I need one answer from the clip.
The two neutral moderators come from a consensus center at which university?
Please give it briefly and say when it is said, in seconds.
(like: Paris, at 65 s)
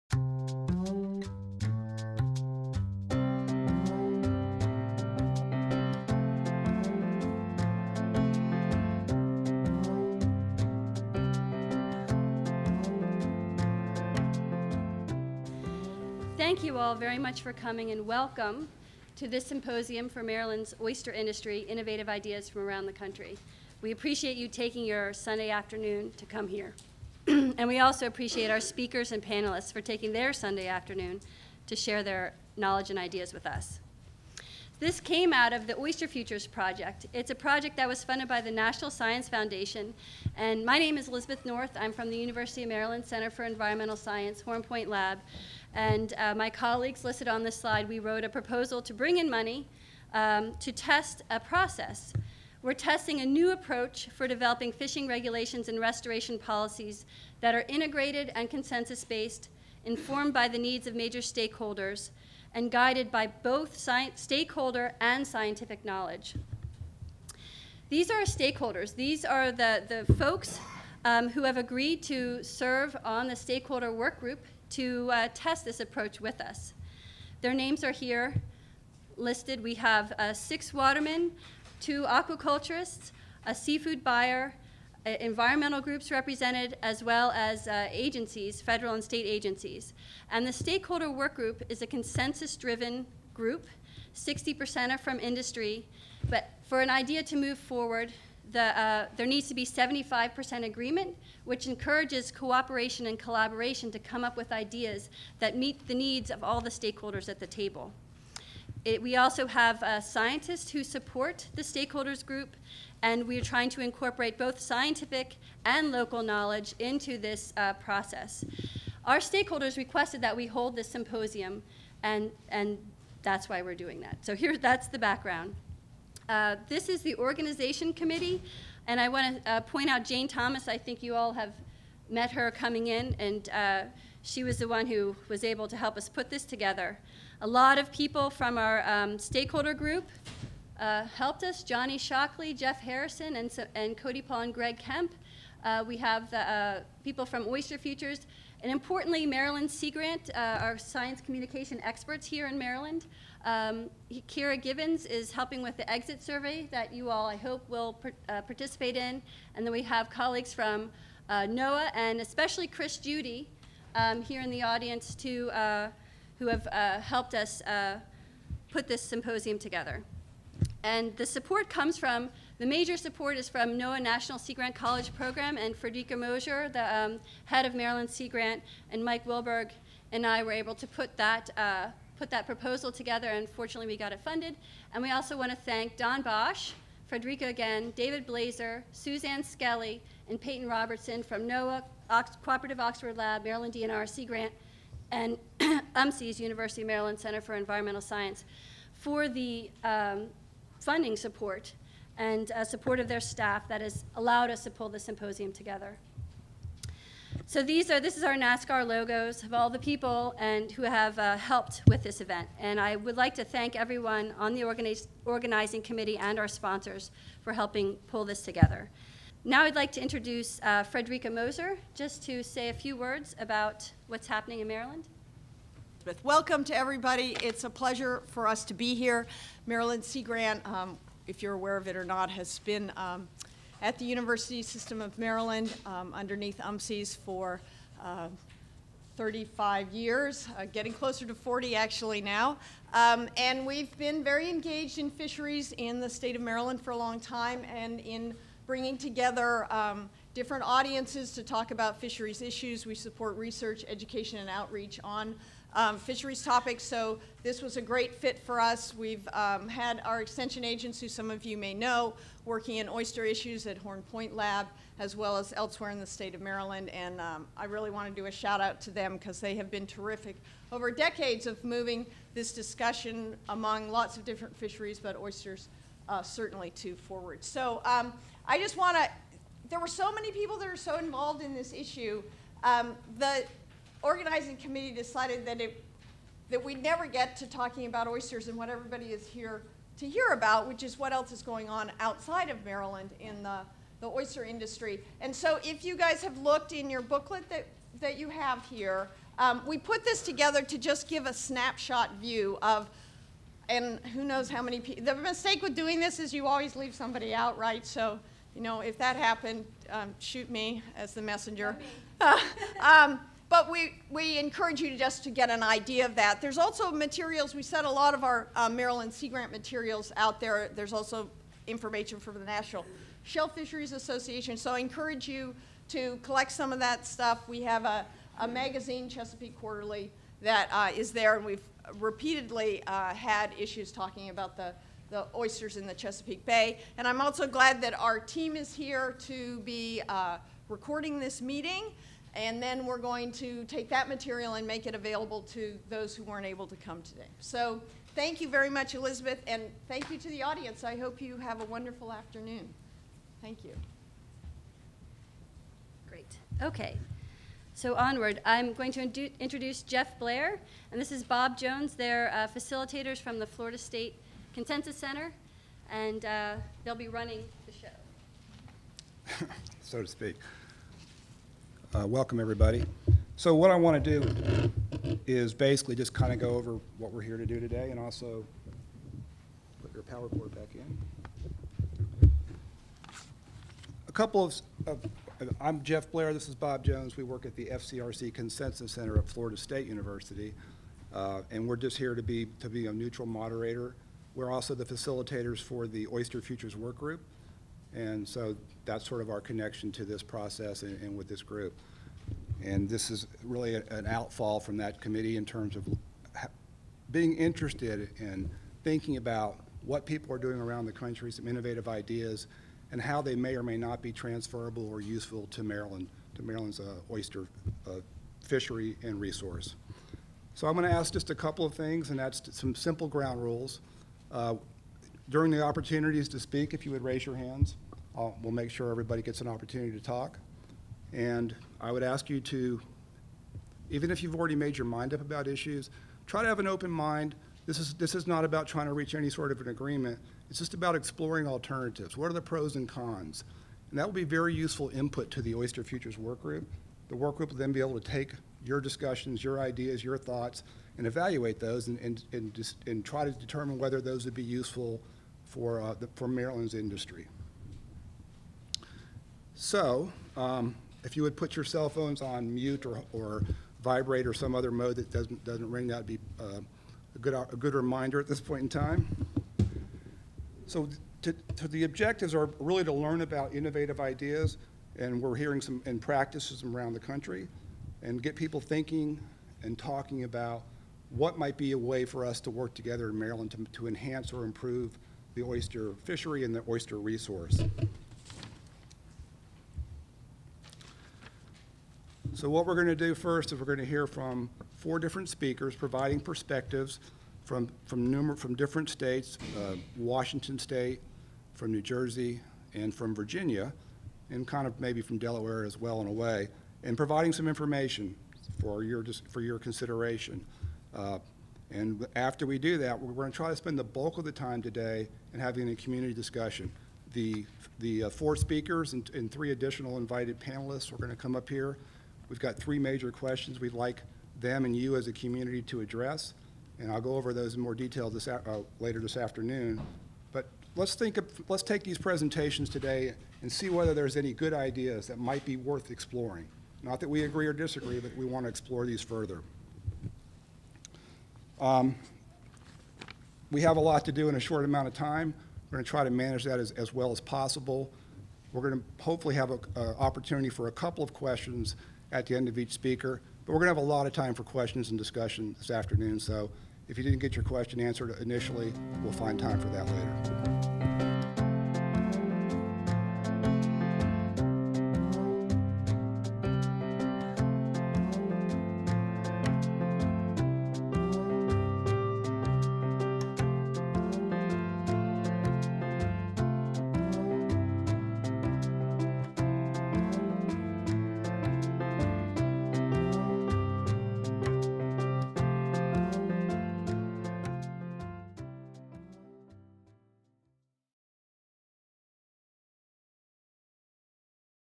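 Florida State University, at 389 s.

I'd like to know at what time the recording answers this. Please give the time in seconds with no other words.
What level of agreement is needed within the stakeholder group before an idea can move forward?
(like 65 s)
99 s.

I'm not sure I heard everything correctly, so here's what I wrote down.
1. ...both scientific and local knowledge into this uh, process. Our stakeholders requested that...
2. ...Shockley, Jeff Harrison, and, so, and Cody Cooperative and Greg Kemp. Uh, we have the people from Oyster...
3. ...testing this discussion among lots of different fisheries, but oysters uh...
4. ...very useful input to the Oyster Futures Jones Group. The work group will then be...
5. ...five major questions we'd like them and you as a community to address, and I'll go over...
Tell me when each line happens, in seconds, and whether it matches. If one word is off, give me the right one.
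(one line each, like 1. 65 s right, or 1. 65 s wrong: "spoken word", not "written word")
1. 114 s right
2. 141 s wrong: "Paul", not "Cooperative"
3. 271 s wrong: "moving", not "testing"
4. 444 s wrong: "Work", not "Jones"
5. 522 s wrong: "three", not "five".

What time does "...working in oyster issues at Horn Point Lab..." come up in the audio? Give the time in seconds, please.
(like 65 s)
262 s.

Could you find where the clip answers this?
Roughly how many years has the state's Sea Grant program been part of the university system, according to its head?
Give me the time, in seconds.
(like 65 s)
239 s.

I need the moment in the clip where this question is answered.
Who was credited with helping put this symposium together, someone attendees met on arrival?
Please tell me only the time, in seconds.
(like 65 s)
130 s.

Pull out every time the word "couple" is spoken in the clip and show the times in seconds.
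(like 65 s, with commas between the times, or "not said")
384 s, 421 s, 550 s.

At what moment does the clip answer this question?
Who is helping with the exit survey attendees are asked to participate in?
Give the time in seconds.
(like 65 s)
154 s.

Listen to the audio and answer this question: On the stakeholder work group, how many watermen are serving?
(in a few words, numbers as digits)
6.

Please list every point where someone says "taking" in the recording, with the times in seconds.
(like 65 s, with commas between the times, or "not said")
24 s, 29 s.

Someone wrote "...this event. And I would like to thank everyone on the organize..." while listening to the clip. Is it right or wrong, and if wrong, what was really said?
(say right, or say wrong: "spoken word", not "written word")
right.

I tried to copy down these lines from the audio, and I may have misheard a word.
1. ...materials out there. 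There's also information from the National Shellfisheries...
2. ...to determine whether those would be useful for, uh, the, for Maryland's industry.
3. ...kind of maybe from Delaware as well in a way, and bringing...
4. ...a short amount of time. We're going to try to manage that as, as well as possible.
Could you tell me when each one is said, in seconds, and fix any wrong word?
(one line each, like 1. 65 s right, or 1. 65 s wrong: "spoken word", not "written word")
1. 319 s right
2. 453 s right
3. 504 s wrong: "providing", not "bringing"
4. 544 s right.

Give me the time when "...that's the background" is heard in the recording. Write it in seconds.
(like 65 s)
124 s.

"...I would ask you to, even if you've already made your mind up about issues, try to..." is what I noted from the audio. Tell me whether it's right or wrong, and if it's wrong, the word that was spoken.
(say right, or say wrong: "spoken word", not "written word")
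right.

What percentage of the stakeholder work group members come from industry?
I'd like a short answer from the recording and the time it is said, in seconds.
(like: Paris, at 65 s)
60%, at 94 s.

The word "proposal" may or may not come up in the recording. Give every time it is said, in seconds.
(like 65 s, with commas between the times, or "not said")
48 s, 182 s.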